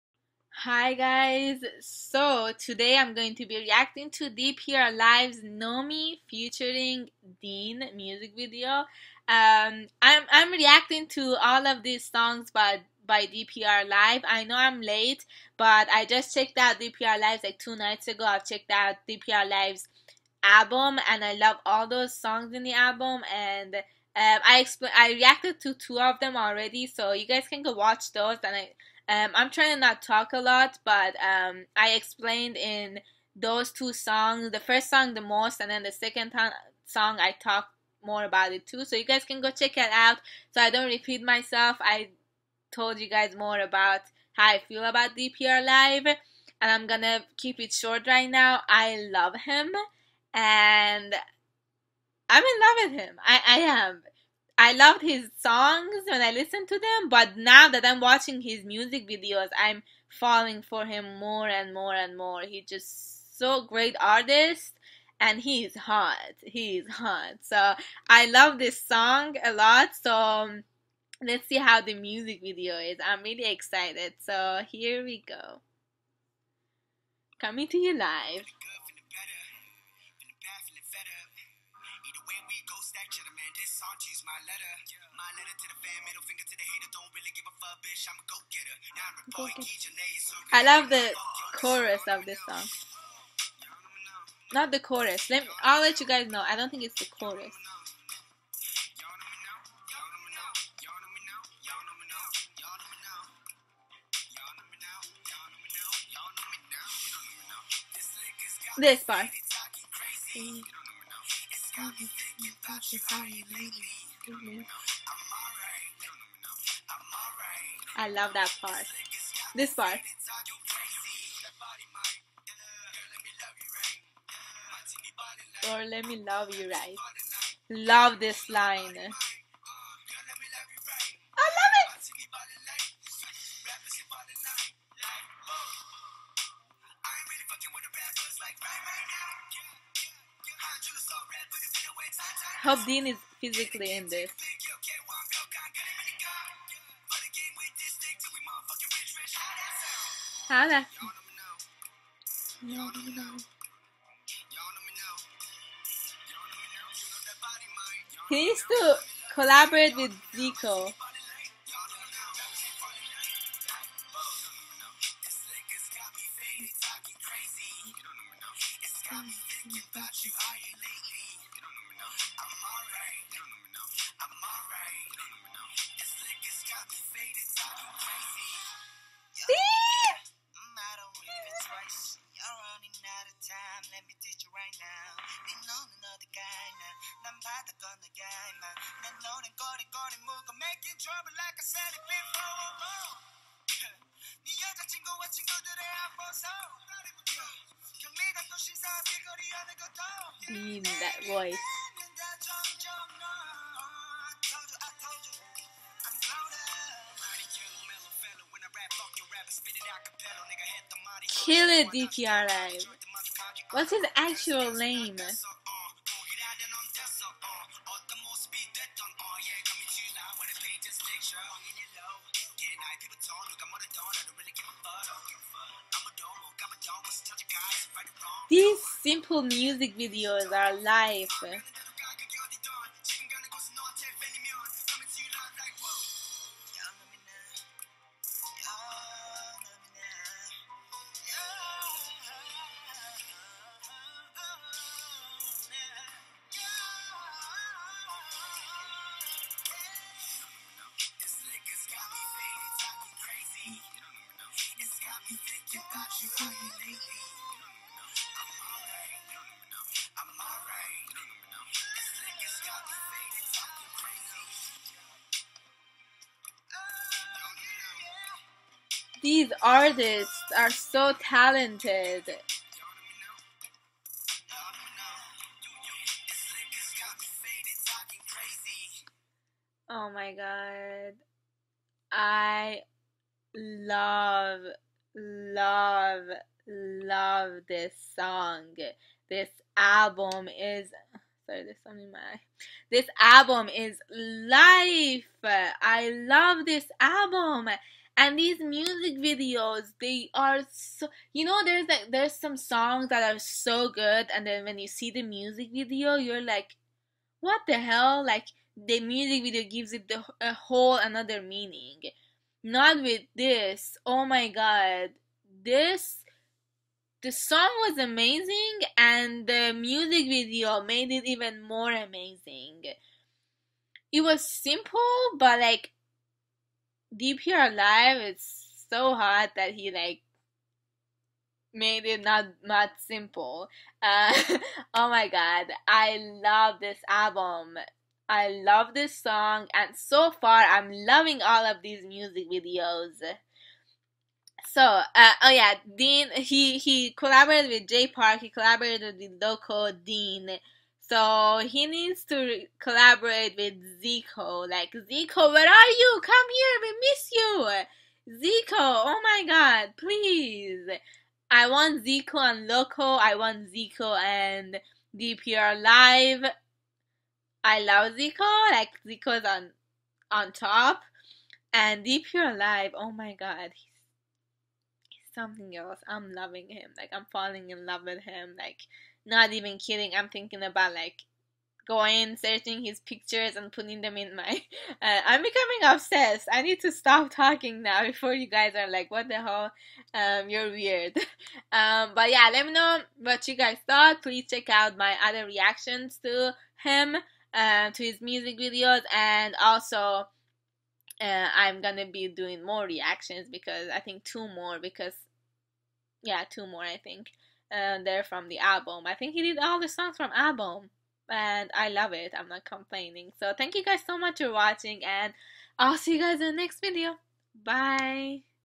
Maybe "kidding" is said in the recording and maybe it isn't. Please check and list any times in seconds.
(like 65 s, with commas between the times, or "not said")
379 s.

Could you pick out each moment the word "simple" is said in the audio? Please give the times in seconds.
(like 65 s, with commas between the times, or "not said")
324 s, 333 s.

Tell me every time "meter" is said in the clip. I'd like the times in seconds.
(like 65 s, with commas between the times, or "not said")
not said.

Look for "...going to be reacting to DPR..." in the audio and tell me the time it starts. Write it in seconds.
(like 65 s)
3 s.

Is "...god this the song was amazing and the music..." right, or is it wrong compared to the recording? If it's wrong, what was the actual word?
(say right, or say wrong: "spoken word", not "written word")
right.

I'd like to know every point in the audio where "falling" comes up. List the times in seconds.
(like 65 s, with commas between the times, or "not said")
60 s, 377 s.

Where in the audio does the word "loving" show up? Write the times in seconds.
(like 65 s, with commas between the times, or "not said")
340 s, 376 s.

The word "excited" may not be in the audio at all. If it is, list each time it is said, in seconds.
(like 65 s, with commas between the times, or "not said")
73 s.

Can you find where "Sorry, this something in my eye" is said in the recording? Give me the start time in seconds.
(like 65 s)
291 s.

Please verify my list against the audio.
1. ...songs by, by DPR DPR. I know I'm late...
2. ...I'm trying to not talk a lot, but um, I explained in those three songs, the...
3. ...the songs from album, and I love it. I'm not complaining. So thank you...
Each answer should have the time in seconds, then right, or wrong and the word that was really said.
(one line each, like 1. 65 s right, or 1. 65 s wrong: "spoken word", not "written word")
1. 12 s wrong: "Live", not "DPR"
2. 29 s wrong: "two", not "three"
3. 409 s right.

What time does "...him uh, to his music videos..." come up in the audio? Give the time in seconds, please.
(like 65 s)
396 s.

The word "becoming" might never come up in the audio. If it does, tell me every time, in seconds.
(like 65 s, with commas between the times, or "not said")
385 s.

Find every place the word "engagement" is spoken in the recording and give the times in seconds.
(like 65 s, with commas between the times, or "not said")
not said.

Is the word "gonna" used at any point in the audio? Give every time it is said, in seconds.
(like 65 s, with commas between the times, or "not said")
46 s, 401 s.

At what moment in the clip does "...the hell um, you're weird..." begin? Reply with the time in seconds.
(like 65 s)
389 s.